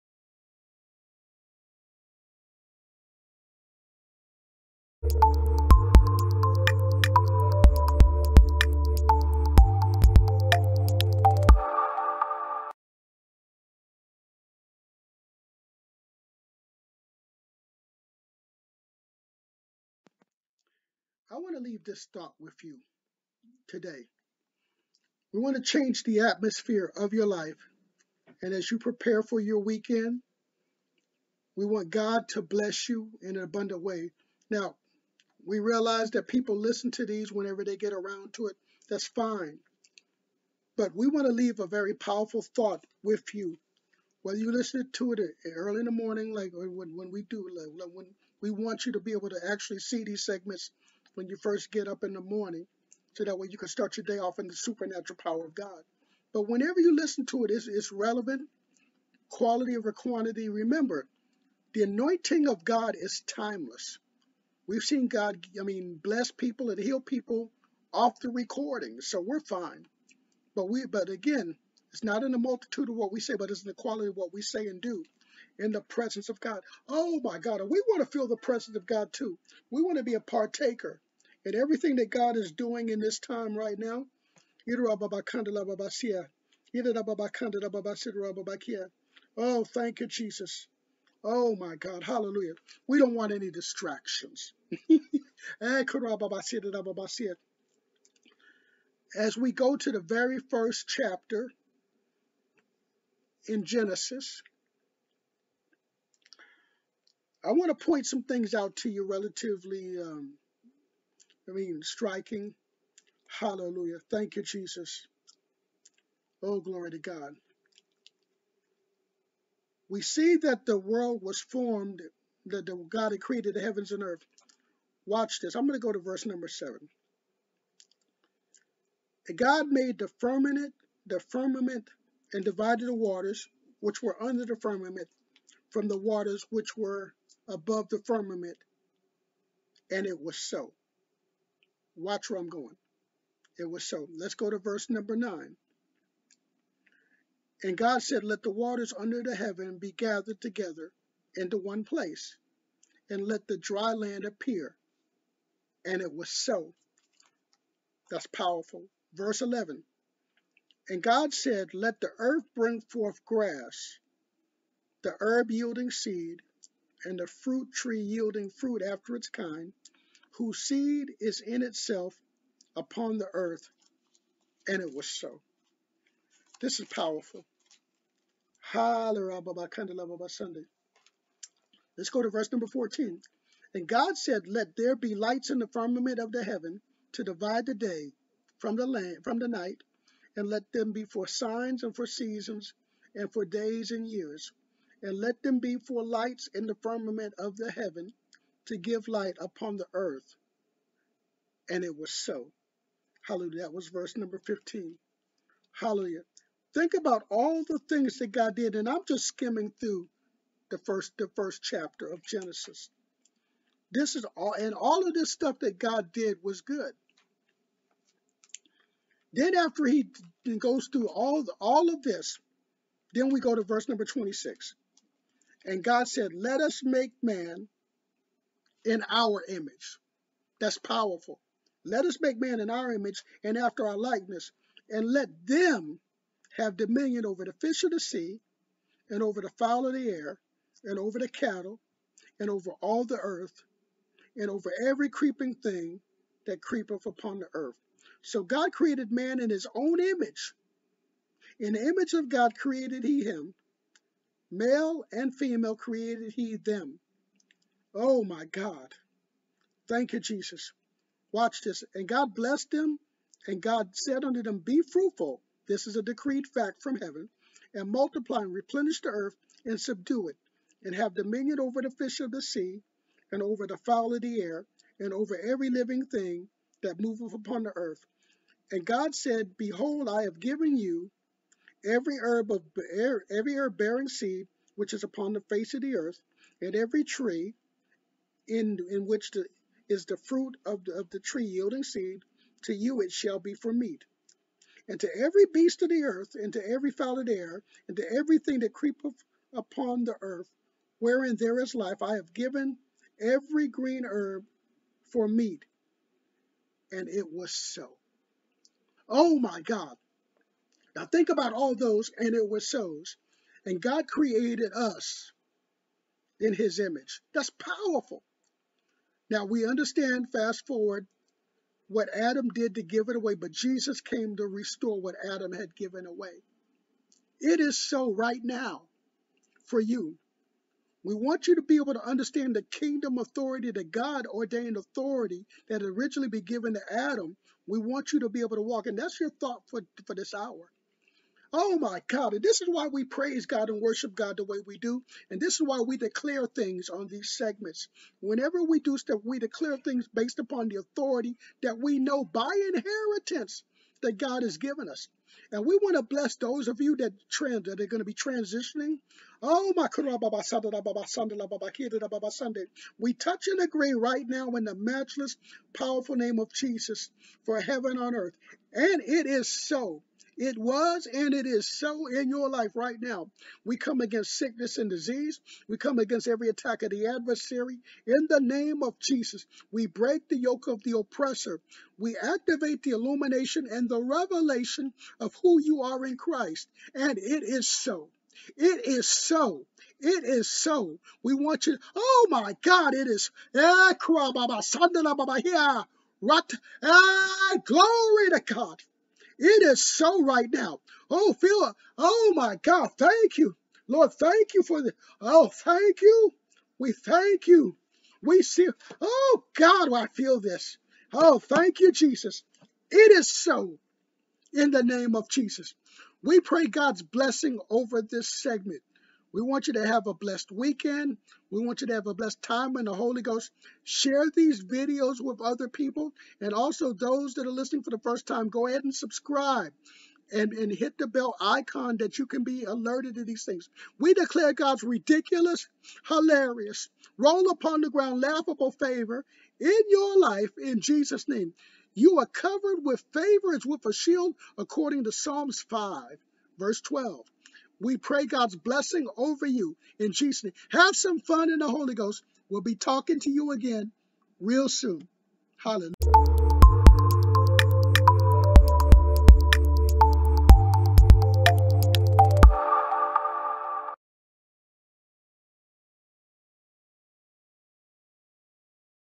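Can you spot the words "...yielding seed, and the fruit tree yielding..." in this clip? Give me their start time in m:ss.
2:45.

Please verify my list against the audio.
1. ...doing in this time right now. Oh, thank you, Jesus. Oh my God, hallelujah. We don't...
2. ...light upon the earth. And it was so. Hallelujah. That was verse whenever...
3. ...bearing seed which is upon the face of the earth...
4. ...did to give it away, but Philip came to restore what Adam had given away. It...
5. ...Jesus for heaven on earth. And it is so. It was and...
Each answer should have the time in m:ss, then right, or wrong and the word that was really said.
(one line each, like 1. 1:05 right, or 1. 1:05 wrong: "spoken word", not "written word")
1. 1:22 right
2. 3:19 wrong: "number", not "whenever"
3. 4:43 right
4. 5:22 wrong: "Jesus", not "Philip"
5. 6:06 right.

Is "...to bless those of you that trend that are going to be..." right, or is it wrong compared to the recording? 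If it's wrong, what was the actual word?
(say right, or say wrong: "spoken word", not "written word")
right.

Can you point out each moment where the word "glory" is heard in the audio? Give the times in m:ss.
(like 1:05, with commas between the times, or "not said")
1:56, 6:37.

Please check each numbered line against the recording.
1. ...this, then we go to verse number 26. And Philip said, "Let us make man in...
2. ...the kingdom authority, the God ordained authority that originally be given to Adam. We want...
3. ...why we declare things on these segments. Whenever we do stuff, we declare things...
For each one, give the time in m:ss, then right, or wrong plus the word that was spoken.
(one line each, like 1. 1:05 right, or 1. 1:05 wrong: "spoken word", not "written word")
1. 3:42 wrong: "God", not "Philip"
2. 5:32 right
3. 5:45 right.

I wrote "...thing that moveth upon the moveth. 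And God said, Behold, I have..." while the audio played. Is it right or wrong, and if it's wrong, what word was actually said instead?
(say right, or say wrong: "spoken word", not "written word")
wrong: "earth", not "moveth".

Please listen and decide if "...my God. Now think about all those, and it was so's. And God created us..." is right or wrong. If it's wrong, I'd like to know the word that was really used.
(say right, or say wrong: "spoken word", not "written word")
right.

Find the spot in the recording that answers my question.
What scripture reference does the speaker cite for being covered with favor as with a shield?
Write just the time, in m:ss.
7:25.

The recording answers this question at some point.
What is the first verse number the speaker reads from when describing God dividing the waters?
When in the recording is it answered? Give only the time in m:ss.
2:05.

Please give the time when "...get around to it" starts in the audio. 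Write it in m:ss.
0:37.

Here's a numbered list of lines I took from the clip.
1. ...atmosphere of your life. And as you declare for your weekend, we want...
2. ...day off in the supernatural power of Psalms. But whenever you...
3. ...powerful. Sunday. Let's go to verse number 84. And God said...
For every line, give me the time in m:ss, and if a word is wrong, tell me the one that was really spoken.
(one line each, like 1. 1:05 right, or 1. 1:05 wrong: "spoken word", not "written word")
1. 0:26 wrong: "prepare", not "declare"
2. 0:54 wrong: "God", not "Psalms"
3. 2:56 wrong: "14", not "84".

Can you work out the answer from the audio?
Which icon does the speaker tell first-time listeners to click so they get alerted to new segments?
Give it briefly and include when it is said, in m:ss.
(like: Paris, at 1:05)
the bell icon, at 7:11.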